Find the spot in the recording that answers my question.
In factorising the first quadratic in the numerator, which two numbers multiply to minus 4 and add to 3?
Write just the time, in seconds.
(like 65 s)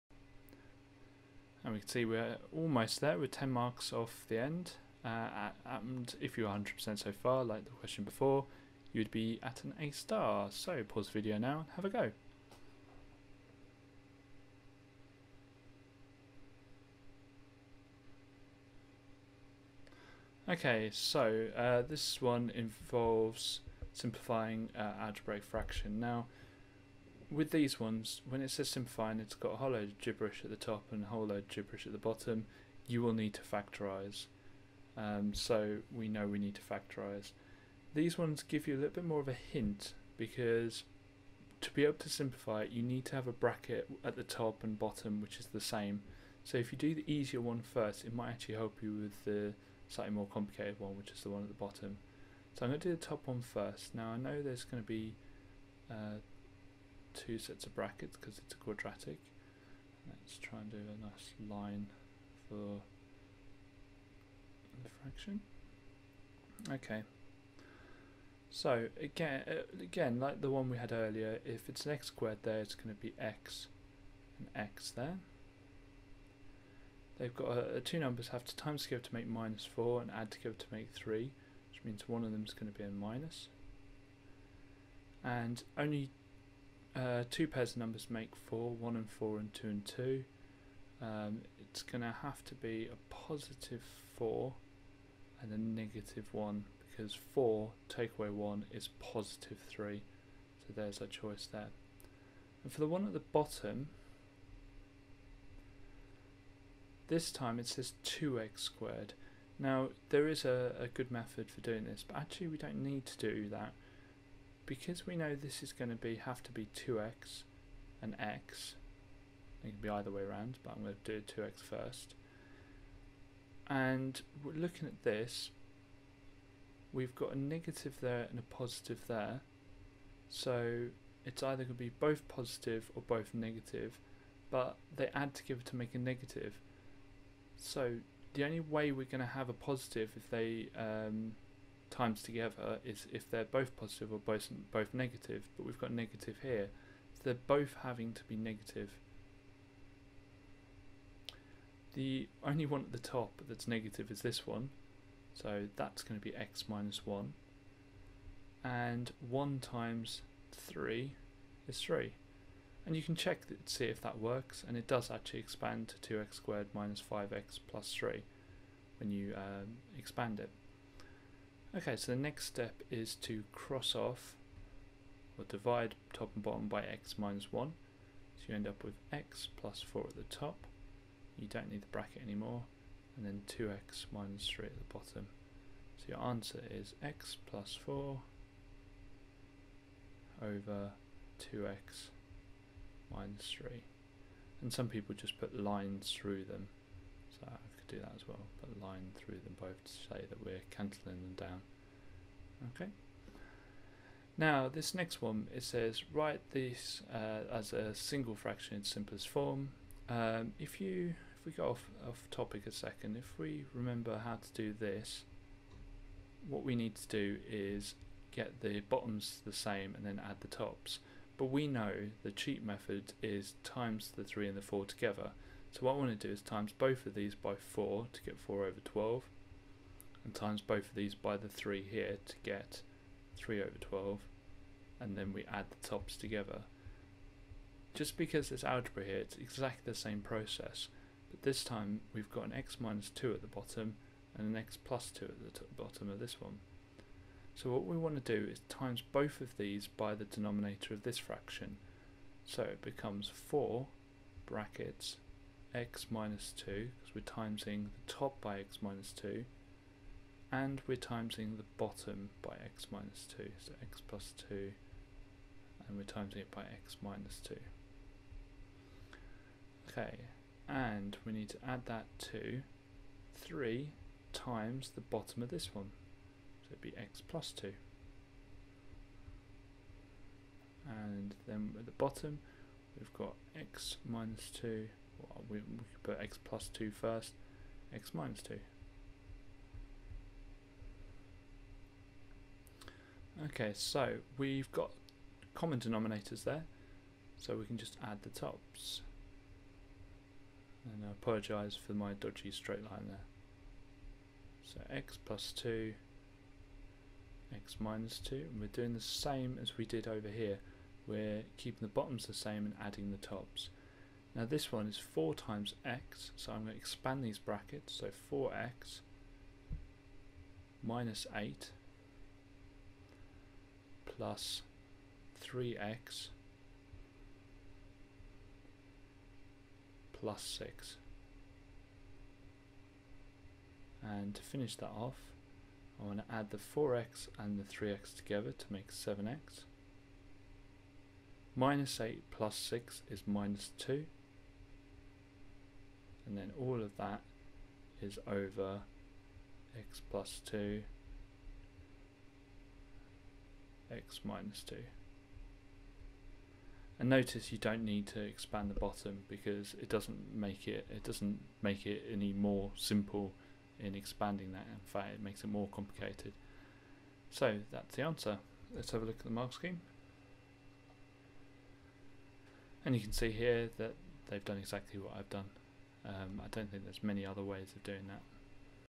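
93 s.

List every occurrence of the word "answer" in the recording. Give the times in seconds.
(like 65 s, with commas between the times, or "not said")
186 s, 368 s.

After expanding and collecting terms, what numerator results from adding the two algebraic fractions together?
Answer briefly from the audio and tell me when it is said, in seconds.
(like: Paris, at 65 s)
7x minus 2, at 338 s.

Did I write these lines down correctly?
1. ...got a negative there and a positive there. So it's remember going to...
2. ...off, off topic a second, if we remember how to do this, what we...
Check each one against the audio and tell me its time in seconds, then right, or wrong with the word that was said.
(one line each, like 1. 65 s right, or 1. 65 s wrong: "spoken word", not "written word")
1. 127 s wrong: "either", not "remember"
2. 211 s right.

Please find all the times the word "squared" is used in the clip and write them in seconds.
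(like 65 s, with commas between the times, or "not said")
72 s, 108 s, 166 s.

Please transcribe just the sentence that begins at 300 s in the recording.
And I apologise for my dodgy straight line there.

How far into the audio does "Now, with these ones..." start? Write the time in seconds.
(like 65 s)
26 s.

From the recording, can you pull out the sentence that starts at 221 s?
But we know the cheat method is times the 3 and the 4 together.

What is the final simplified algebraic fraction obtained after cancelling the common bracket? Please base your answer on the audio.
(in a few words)
x plus 4 over 2x minus 3.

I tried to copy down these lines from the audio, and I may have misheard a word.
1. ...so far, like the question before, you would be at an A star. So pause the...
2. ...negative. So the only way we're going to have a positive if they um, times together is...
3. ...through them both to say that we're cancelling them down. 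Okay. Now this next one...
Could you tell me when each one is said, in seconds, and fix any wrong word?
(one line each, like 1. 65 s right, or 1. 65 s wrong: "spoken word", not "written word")
1. 6 s right
2. 135 s right
3. 199 s right.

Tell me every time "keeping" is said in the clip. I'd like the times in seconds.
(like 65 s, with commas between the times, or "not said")
311 s.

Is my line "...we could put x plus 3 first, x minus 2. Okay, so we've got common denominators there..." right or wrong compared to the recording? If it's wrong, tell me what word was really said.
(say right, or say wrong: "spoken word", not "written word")
wrong: "2", not "3".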